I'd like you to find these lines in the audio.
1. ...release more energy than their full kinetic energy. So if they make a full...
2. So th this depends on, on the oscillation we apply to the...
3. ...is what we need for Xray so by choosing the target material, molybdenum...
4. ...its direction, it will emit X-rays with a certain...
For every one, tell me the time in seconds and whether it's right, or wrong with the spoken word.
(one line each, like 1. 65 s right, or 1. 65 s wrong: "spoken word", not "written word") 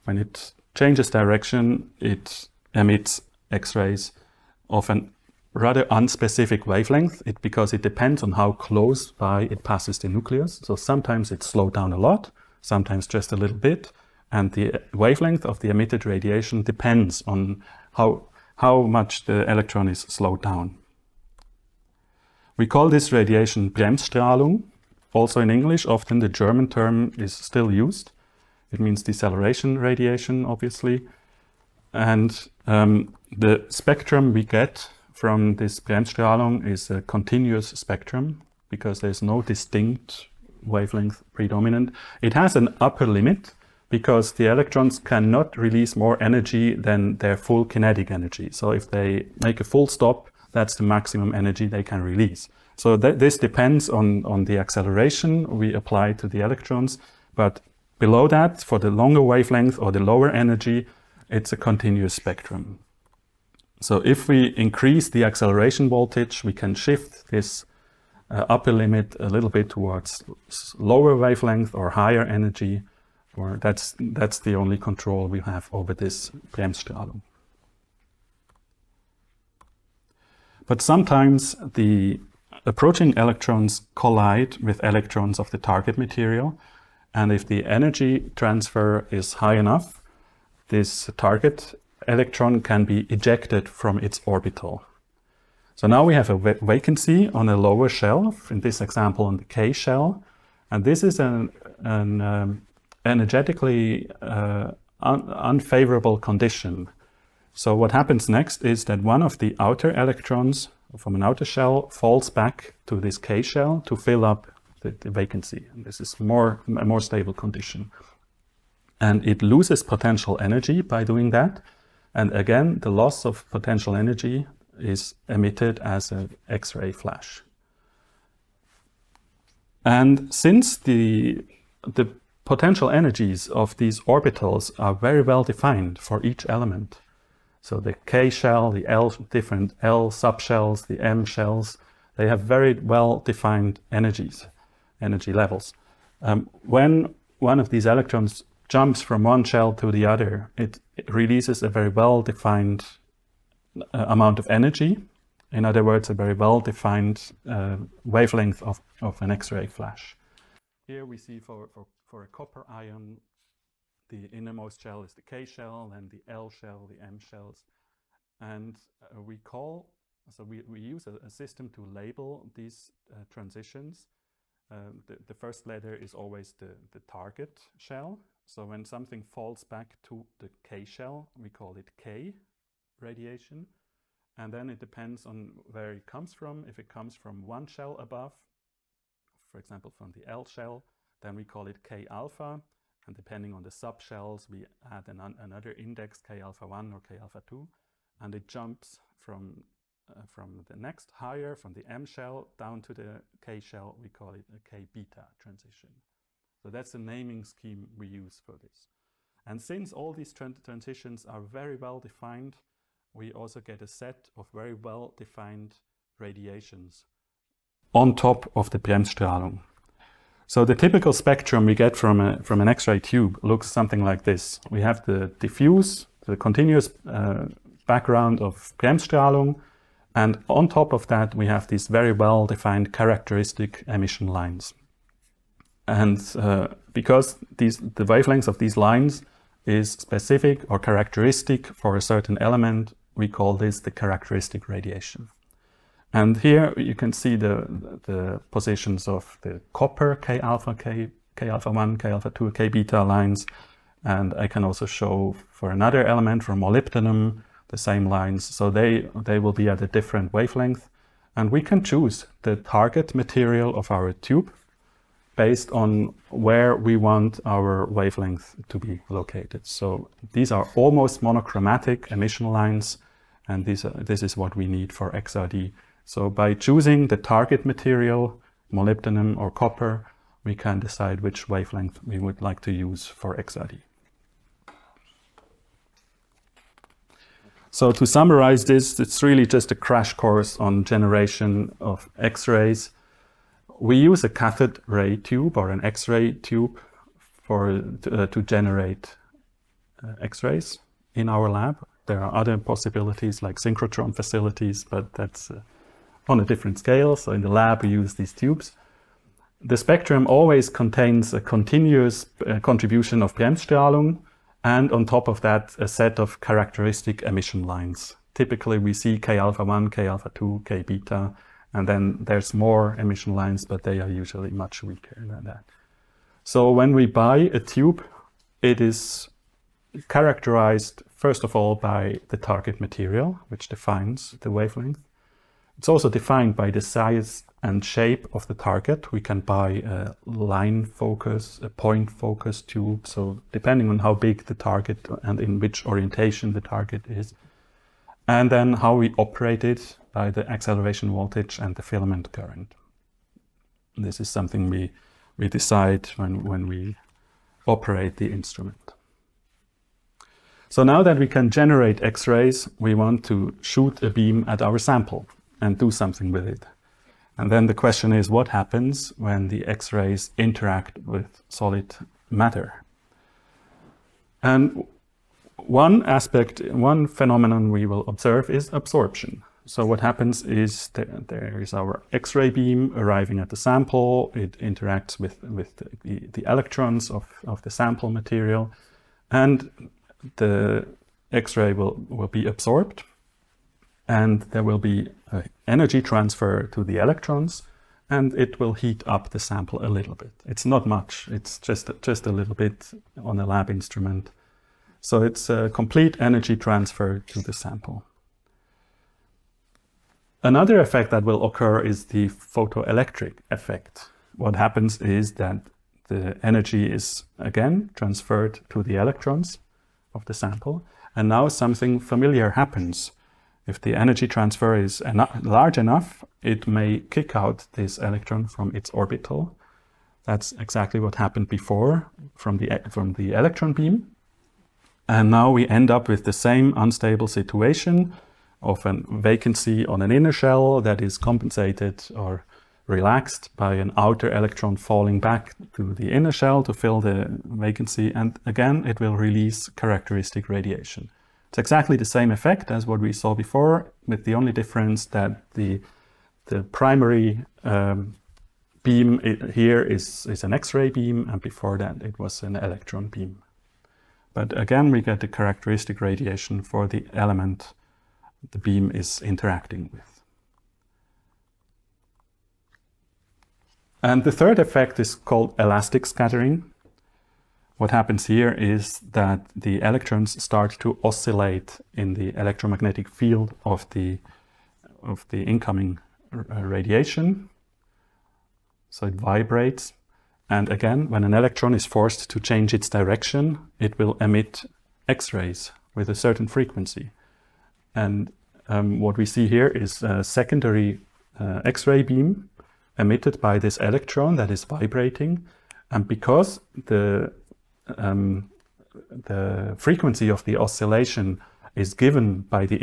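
1. 45 s right
2. 52 s wrong: "acceleration", not "oscillation"
3. 274 s wrong: "XRD", not "Xray"
4. 492 s right.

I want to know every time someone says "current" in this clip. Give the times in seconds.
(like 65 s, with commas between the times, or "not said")
352 s.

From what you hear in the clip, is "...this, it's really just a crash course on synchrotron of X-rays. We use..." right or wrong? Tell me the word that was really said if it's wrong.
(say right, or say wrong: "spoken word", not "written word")
wrong: "generation", not "synchrotron".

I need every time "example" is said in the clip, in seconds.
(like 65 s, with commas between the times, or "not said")
98 s, 189 s.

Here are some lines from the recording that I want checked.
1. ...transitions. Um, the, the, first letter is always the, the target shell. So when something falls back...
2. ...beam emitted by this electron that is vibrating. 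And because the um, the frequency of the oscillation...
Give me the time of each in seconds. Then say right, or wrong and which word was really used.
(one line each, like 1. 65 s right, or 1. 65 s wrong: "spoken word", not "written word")
1. 173 s right
2. 502 s right.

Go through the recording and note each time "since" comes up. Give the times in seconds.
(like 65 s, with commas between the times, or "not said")
130 s, 209 s.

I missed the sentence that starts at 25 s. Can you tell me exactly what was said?
Also in English, often the German term is still used.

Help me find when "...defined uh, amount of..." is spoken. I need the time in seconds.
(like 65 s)
152 s.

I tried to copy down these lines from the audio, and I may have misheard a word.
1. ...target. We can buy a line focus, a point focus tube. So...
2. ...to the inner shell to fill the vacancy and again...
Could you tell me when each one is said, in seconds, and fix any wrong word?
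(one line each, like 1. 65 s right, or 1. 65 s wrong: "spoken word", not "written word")
1. 338 s right
2. 445 s right.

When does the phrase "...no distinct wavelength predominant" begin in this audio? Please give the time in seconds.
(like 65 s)
39 s.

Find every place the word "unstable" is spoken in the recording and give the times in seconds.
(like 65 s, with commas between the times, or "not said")
436 s.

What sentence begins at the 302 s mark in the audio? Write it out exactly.
There are other possibilities like synchrotron facilities, but that's uh, on a different scale.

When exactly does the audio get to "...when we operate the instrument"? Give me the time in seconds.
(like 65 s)
356 s.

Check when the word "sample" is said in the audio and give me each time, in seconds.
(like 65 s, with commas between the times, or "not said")
364 s, 383 s, 387 s, 399 s, 407 s, 420 s.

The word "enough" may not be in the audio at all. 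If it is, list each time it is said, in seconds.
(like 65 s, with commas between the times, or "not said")
89 s, 425 s.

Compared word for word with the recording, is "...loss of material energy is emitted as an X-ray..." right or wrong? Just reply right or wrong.
wrong.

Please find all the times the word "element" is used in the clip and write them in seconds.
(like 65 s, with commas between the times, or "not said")
136 s, 242 s, 256 s, 467 s.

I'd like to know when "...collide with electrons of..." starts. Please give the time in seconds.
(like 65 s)
83 s.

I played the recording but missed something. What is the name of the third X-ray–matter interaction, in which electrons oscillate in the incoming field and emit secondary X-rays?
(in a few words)
Elastic scattering.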